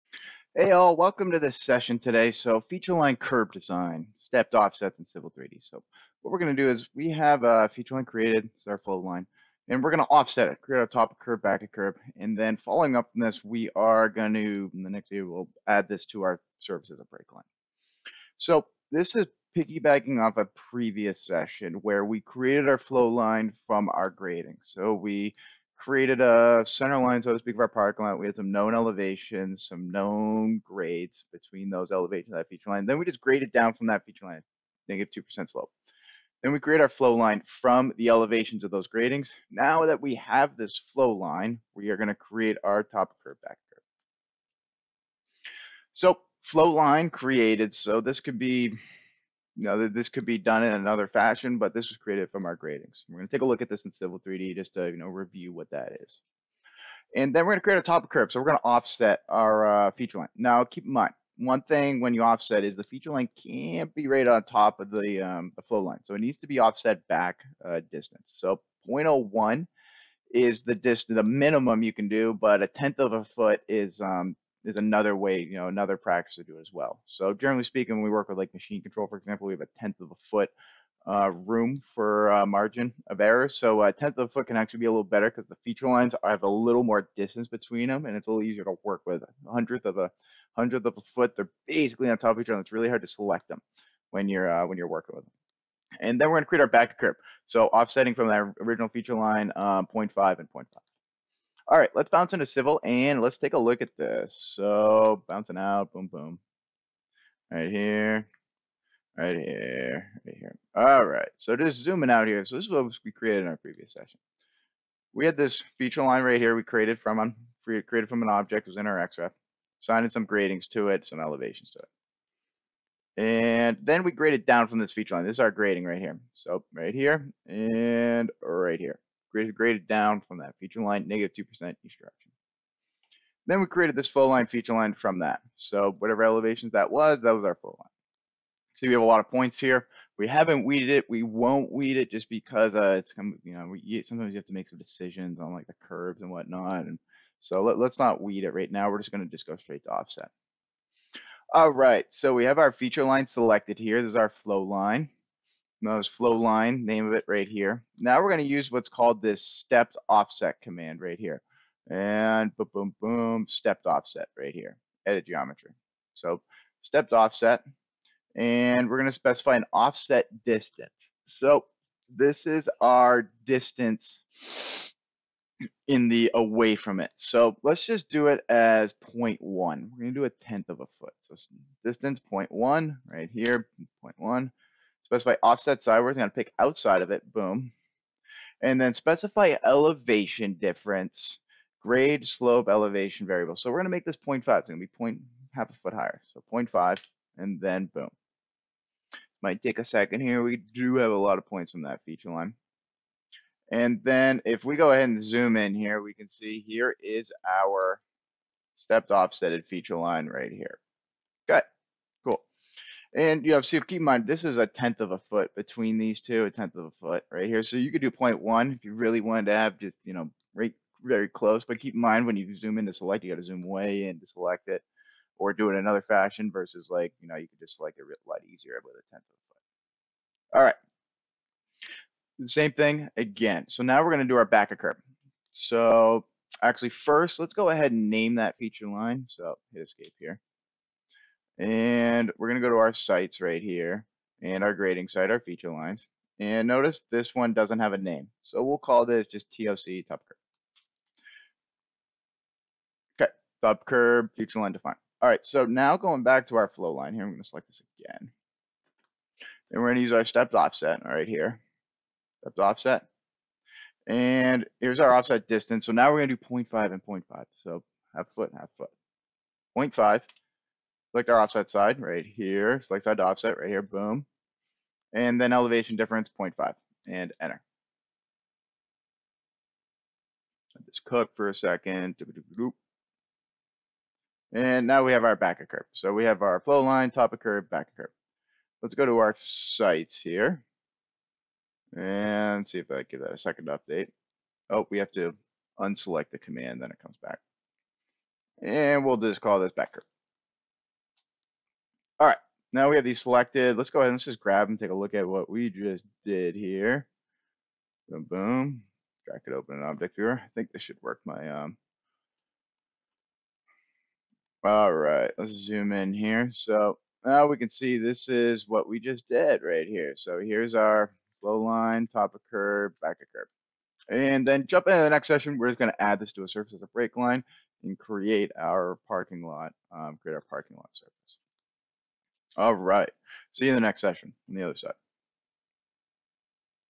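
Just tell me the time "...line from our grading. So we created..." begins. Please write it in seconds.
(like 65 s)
23 s.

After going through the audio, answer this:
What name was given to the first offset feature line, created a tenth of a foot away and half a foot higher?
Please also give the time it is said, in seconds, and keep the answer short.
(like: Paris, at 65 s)
TOC, at 249 s.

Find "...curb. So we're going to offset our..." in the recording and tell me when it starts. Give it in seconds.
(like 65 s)
58 s.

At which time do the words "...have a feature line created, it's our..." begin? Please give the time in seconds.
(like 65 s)
7 s.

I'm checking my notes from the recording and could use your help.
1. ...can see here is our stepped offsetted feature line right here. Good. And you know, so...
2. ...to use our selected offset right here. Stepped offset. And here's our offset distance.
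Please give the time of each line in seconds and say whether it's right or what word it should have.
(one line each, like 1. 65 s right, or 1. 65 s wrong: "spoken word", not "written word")
1. 206 s right
2. 259 s wrong: "stepped", not "selected".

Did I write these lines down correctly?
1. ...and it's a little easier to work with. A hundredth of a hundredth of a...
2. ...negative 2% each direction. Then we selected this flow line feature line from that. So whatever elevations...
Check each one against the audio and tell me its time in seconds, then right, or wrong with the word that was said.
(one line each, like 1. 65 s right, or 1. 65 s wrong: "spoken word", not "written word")
1. 88 s right
2. 131 s wrong: "created", not "selected".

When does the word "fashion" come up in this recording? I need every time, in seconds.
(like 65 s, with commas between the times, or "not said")
51 s, 226 s.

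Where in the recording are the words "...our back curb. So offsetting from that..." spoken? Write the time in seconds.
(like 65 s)
96 s.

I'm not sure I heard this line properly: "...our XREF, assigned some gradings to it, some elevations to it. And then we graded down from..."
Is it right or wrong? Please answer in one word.
right.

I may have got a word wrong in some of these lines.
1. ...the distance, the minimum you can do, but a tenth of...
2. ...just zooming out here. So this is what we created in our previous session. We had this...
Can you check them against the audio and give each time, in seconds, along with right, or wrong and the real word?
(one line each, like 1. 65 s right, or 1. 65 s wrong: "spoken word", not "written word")
1. 70 s right
2. 111 s right.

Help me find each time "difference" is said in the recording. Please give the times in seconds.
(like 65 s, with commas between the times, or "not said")
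190 s, 275 s.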